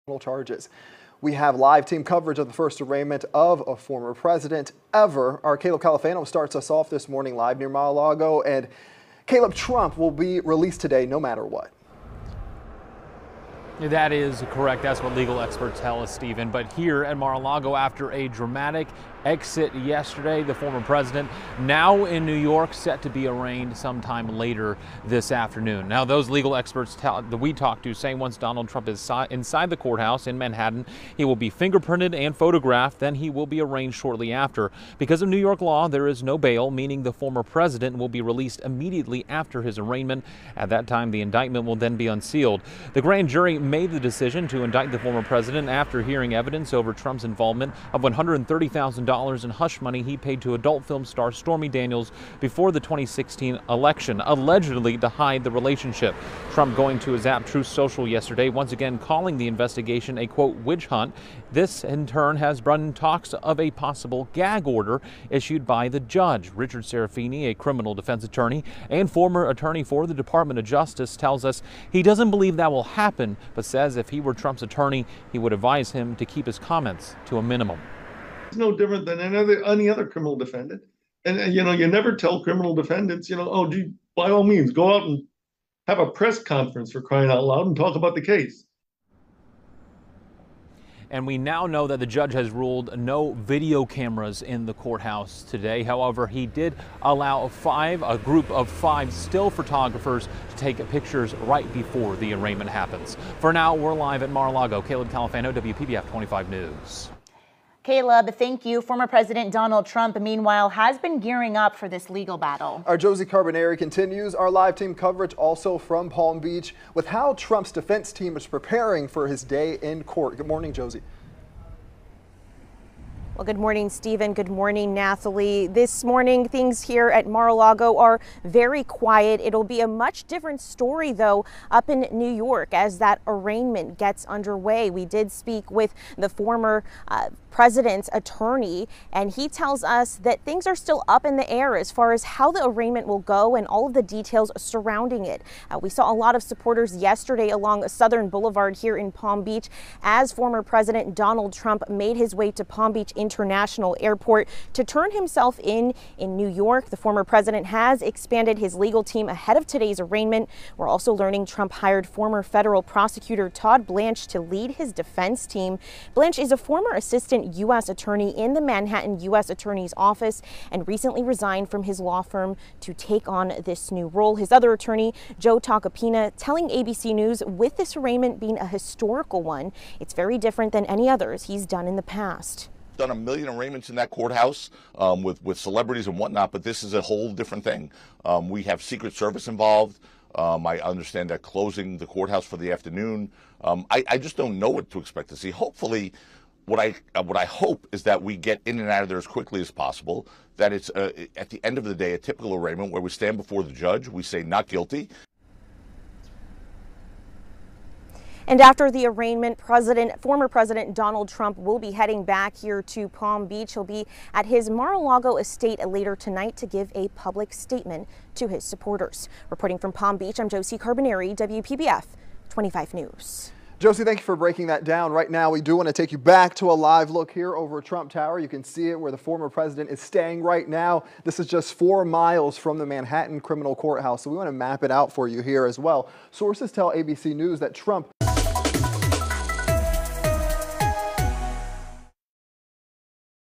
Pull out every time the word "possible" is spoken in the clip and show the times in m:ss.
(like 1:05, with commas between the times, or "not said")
1:03, 3:19.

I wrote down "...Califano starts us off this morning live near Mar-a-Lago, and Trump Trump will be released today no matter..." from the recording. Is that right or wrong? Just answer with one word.
wrong.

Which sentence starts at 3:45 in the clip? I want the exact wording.
Right now, we do want to take you back to a live look here over Trump Tower.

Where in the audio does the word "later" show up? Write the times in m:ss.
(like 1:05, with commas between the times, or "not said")
0:24, 3:35.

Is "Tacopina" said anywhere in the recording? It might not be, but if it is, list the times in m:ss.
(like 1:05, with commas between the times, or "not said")
2:55.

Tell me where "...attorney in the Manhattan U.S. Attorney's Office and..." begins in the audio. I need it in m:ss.
2:47.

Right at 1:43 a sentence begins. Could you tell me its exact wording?
For now, we're live at Mar-a-Lago.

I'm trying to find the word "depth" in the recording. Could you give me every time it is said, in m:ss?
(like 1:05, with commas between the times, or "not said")
not said.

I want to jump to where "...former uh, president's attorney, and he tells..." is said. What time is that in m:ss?
2:16.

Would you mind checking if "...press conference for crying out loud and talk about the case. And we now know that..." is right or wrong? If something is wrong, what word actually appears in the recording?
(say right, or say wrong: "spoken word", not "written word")
right.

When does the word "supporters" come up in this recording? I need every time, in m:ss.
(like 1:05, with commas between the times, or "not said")
2:26, 3:38.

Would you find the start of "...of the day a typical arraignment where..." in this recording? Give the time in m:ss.
3:21.